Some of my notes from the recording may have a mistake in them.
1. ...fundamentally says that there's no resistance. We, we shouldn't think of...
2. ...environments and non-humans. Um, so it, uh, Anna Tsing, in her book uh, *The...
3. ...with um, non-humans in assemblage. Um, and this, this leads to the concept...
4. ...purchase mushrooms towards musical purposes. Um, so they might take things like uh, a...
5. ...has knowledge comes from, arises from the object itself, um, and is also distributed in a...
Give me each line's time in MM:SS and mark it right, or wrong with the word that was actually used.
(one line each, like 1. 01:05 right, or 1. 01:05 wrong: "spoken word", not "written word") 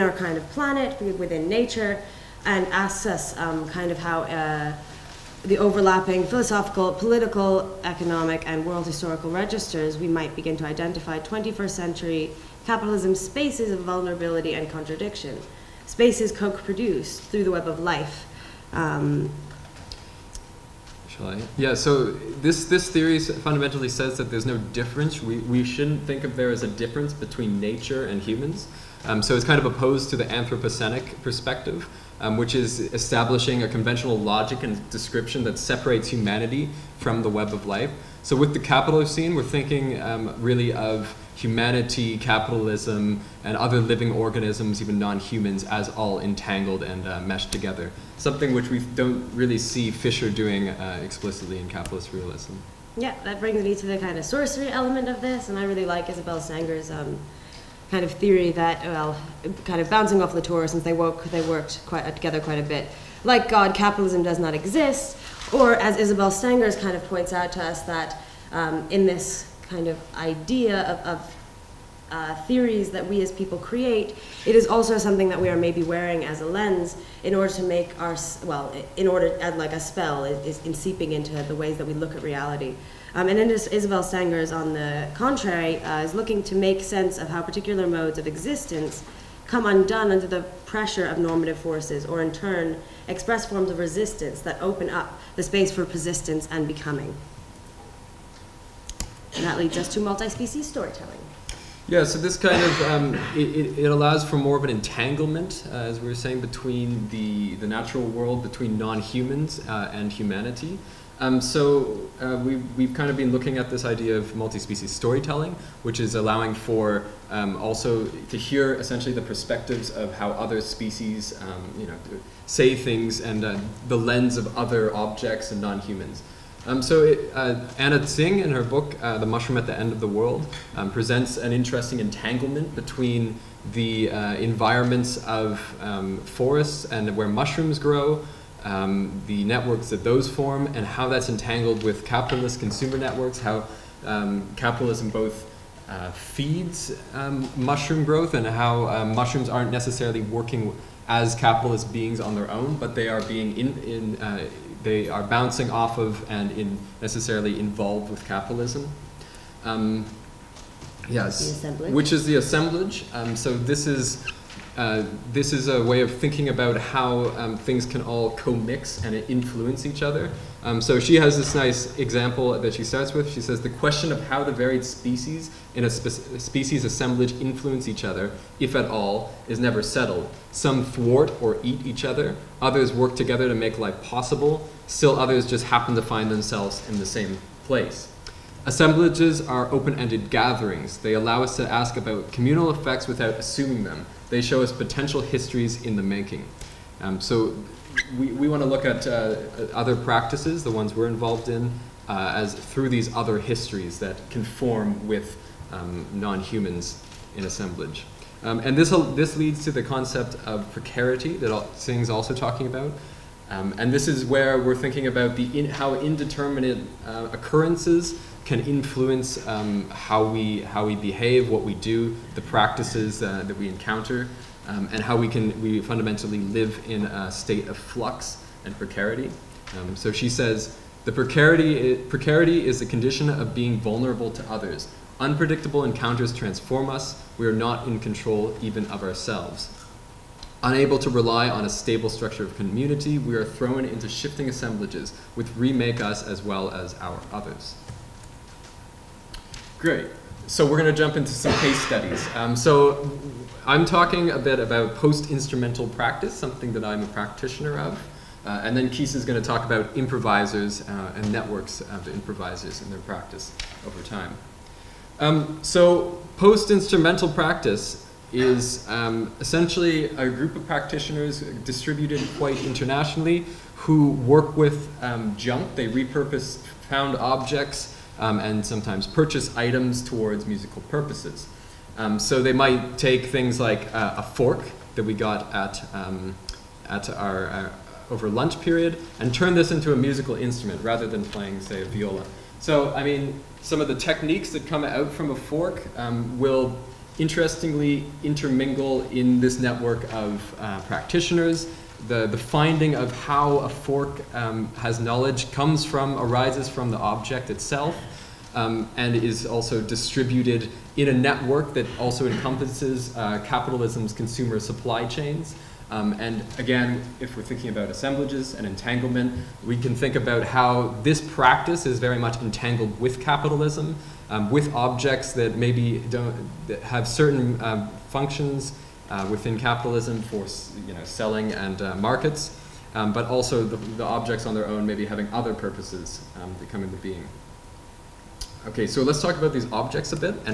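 1. 00:23 wrong: "difference", not "resistance"
2. 02:04 wrong: "objects", not "environments"
3. 03:25 right
4. 04:39 wrong: "items", not "mushrooms"
5. 05:04 right.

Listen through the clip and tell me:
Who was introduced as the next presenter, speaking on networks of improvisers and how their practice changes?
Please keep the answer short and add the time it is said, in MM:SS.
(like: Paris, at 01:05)
Keith, at 04:18.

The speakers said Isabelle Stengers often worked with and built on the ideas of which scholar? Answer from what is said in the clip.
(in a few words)
Latour.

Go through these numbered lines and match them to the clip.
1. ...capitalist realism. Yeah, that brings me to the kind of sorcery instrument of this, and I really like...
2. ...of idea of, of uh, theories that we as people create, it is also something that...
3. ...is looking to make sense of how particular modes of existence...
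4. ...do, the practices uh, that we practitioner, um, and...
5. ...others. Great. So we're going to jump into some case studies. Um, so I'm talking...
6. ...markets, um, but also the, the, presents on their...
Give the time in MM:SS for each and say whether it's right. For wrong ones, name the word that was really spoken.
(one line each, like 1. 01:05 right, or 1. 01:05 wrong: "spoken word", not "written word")
1. 00:51 wrong: "element", not "instrument"
2. 01:09 right
3. 01:26 right
4. 03:41 wrong: "encounter", not "practitioner"
5. 04:07 right
6. 05:31 wrong: "objects", not "presents".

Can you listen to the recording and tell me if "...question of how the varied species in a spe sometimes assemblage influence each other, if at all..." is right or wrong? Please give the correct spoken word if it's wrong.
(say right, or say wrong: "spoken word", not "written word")
wrong: "species", not "sometimes".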